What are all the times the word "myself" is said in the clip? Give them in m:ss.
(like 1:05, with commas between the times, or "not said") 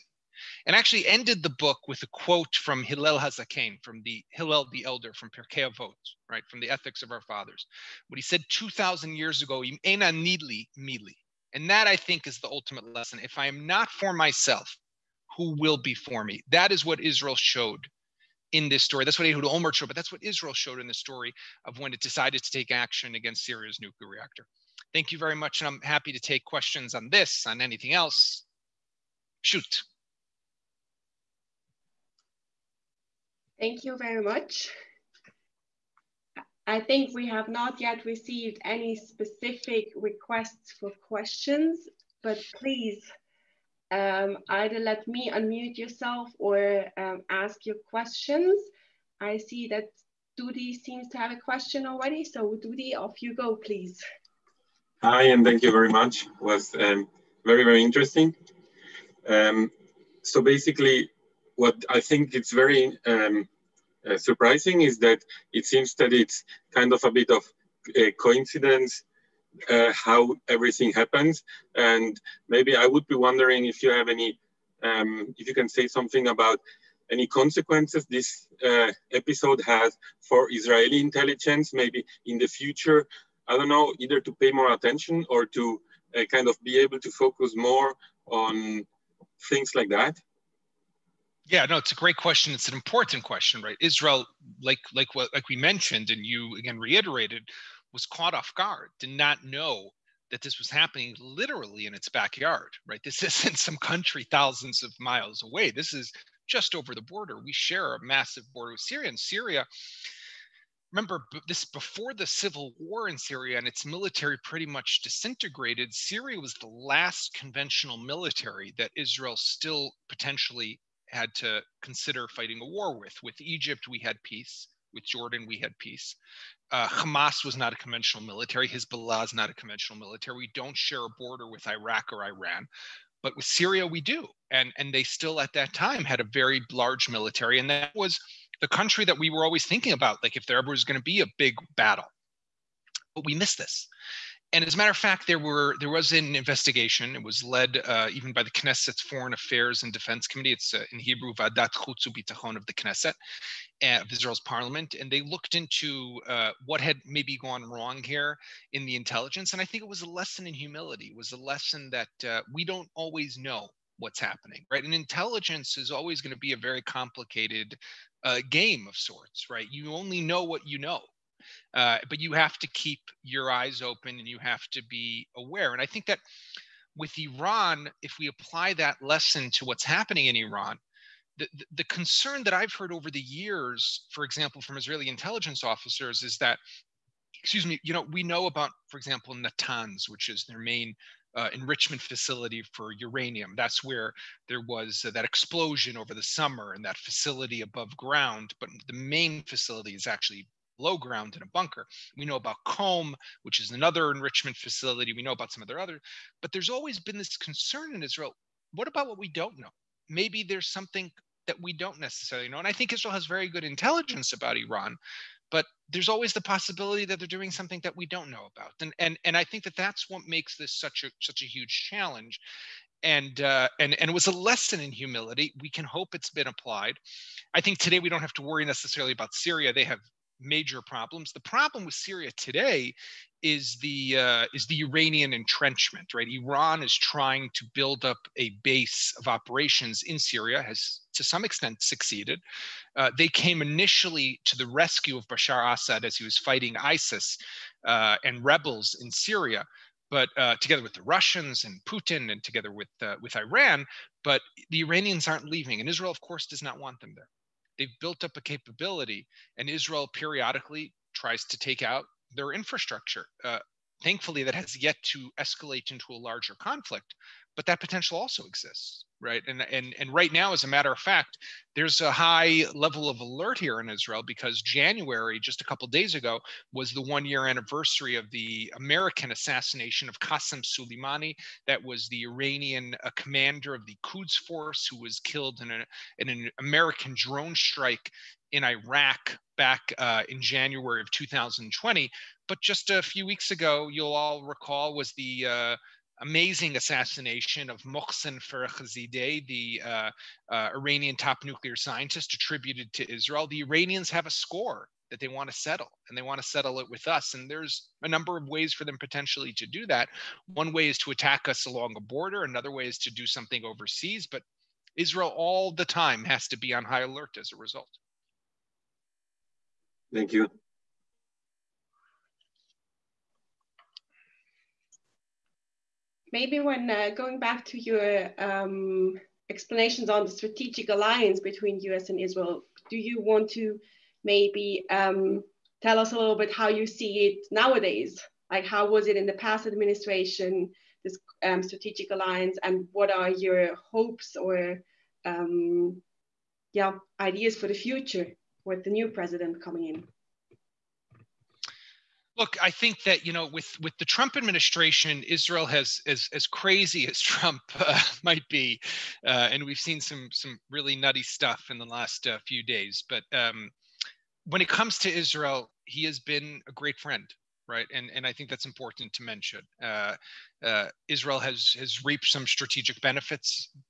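0:14.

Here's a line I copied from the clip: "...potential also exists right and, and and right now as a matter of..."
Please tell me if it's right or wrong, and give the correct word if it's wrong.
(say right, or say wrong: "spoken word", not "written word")
right.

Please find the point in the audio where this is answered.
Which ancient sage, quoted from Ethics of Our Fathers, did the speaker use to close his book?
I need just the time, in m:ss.
0:04.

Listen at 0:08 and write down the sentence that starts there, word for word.
What he said 2,000 years ago, Ena nidli mili.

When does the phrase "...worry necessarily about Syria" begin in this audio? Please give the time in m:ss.
3:48.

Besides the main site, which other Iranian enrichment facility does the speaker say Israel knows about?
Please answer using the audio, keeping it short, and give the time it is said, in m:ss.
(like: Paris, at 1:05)
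Qom, at 3:22.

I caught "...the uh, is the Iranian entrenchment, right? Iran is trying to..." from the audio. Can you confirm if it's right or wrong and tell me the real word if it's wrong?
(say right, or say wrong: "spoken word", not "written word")
right.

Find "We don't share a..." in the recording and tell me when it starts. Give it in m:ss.
2:10.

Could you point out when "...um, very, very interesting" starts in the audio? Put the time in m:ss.
0:56.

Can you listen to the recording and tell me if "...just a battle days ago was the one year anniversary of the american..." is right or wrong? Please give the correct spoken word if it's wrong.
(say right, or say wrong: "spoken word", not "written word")
wrong: "couple", not "battle".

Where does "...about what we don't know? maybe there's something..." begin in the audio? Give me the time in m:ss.
3:28.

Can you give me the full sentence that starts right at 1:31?
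Yeah, no, it's a great question.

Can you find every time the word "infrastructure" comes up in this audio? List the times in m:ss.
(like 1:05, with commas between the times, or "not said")
4:22.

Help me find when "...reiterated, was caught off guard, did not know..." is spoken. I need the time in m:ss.
1:36.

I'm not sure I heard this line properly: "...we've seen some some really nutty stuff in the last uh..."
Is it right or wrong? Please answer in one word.
right.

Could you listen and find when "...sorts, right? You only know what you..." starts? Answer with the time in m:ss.
2:48.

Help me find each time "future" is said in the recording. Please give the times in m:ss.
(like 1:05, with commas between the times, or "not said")
1:22, 5:47.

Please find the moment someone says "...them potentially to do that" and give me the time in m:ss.
5:08.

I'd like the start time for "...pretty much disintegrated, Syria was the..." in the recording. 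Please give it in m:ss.
1:54.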